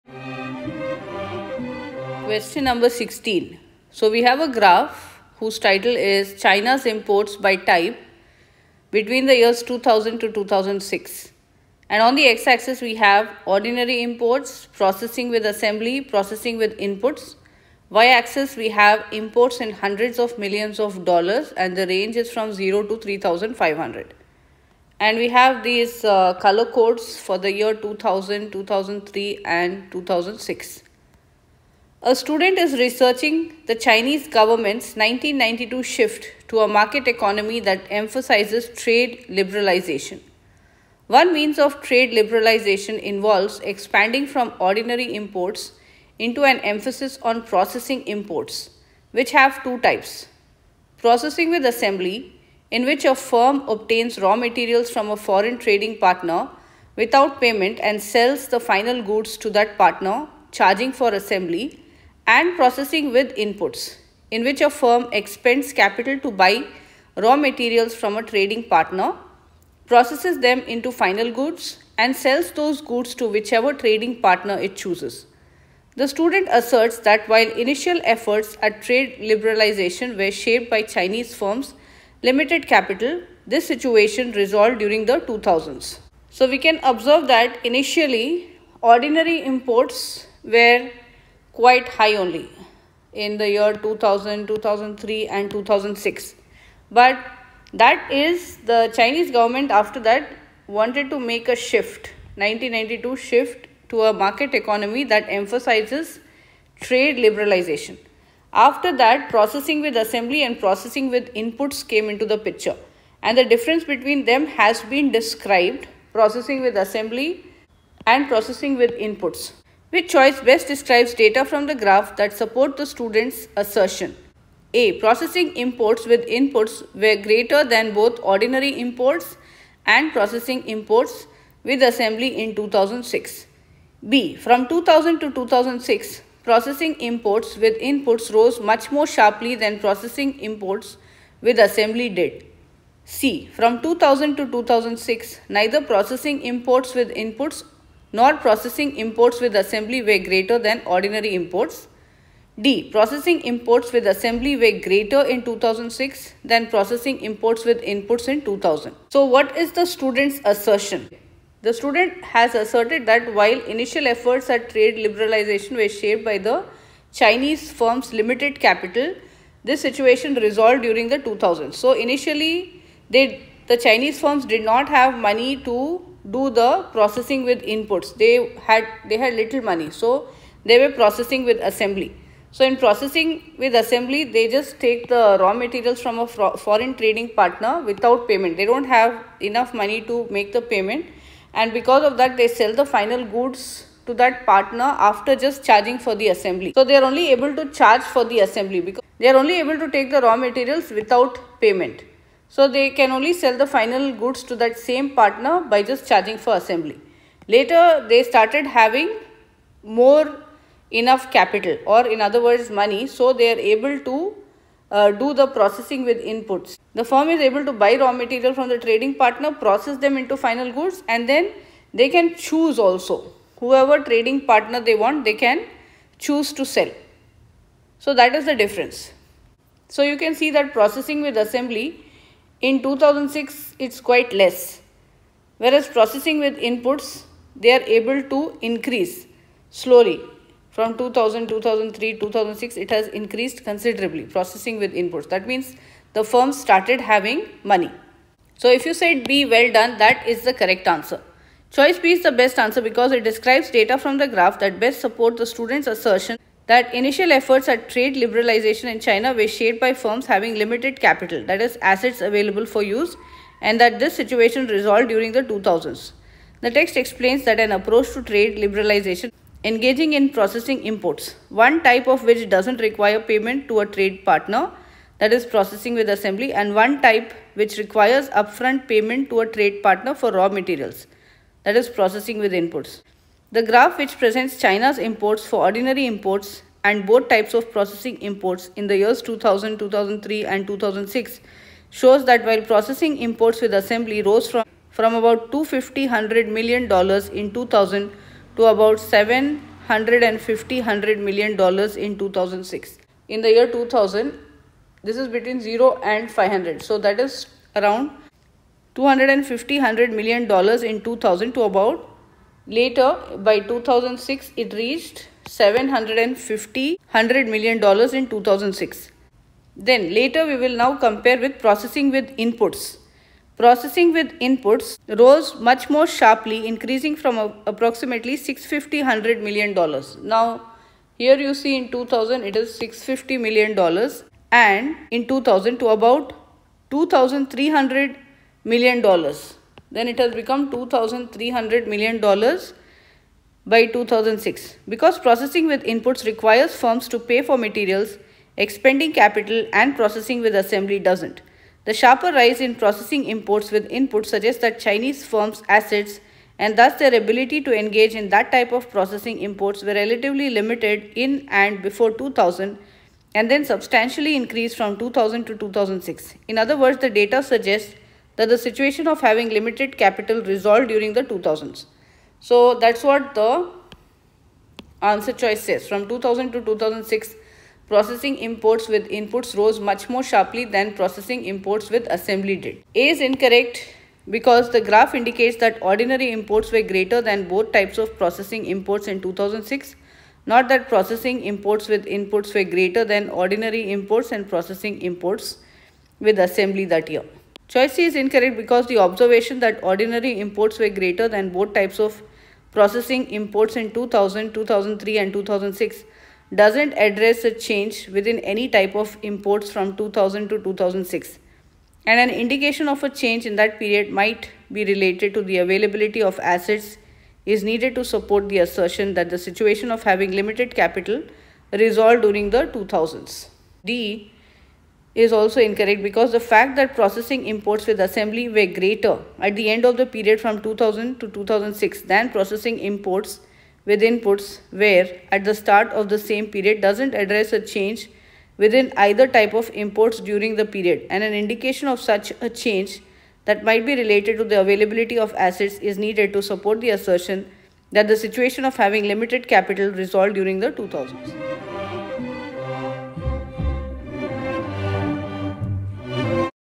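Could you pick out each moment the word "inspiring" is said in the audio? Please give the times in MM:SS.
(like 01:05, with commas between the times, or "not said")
not said.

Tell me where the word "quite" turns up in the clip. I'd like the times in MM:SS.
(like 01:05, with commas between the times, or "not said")
01:31, 03:53.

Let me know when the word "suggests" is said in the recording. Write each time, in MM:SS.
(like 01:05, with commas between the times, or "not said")
05:54, 06:07.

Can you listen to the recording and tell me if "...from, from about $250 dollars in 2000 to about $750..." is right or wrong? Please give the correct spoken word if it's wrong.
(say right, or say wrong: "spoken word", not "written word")
right.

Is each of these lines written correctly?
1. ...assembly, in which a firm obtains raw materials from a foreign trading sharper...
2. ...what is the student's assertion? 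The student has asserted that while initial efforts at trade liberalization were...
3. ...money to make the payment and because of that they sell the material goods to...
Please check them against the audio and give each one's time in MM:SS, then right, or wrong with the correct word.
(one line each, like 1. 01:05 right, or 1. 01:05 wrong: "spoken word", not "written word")
1. 00:51 wrong: "partner", not "sharper"
2. 02:39 right
3. 03:09 wrong: "final", not "material".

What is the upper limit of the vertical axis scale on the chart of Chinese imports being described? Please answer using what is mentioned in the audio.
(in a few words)
3500.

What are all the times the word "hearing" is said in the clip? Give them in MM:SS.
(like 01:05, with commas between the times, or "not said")
not said.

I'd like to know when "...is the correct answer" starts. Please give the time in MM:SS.
04:10.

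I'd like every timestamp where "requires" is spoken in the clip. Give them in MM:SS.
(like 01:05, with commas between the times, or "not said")
04:32, 04:37, 05:46.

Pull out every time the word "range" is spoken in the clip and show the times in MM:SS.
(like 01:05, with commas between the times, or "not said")
00:21.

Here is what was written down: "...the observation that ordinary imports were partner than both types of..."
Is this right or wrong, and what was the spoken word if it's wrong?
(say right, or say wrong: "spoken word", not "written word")
wrong: "greater", not "partner".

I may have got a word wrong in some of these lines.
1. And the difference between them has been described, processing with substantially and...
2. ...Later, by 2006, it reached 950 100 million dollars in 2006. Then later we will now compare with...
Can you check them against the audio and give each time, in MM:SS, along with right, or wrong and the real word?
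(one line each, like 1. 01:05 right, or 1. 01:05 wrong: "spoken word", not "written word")
1. 01:53 wrong: "assembly", not "substantially"
2. 05:12 wrong: "750", not "950".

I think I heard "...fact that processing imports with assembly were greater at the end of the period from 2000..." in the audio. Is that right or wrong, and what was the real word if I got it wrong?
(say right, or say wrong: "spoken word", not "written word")
right.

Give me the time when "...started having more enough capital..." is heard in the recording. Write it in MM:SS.
03:28.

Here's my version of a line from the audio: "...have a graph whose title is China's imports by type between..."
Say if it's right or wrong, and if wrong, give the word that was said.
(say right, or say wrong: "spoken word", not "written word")
right.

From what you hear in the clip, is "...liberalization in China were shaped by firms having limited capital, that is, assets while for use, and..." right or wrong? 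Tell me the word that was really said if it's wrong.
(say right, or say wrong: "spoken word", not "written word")
wrong: "available", not "while".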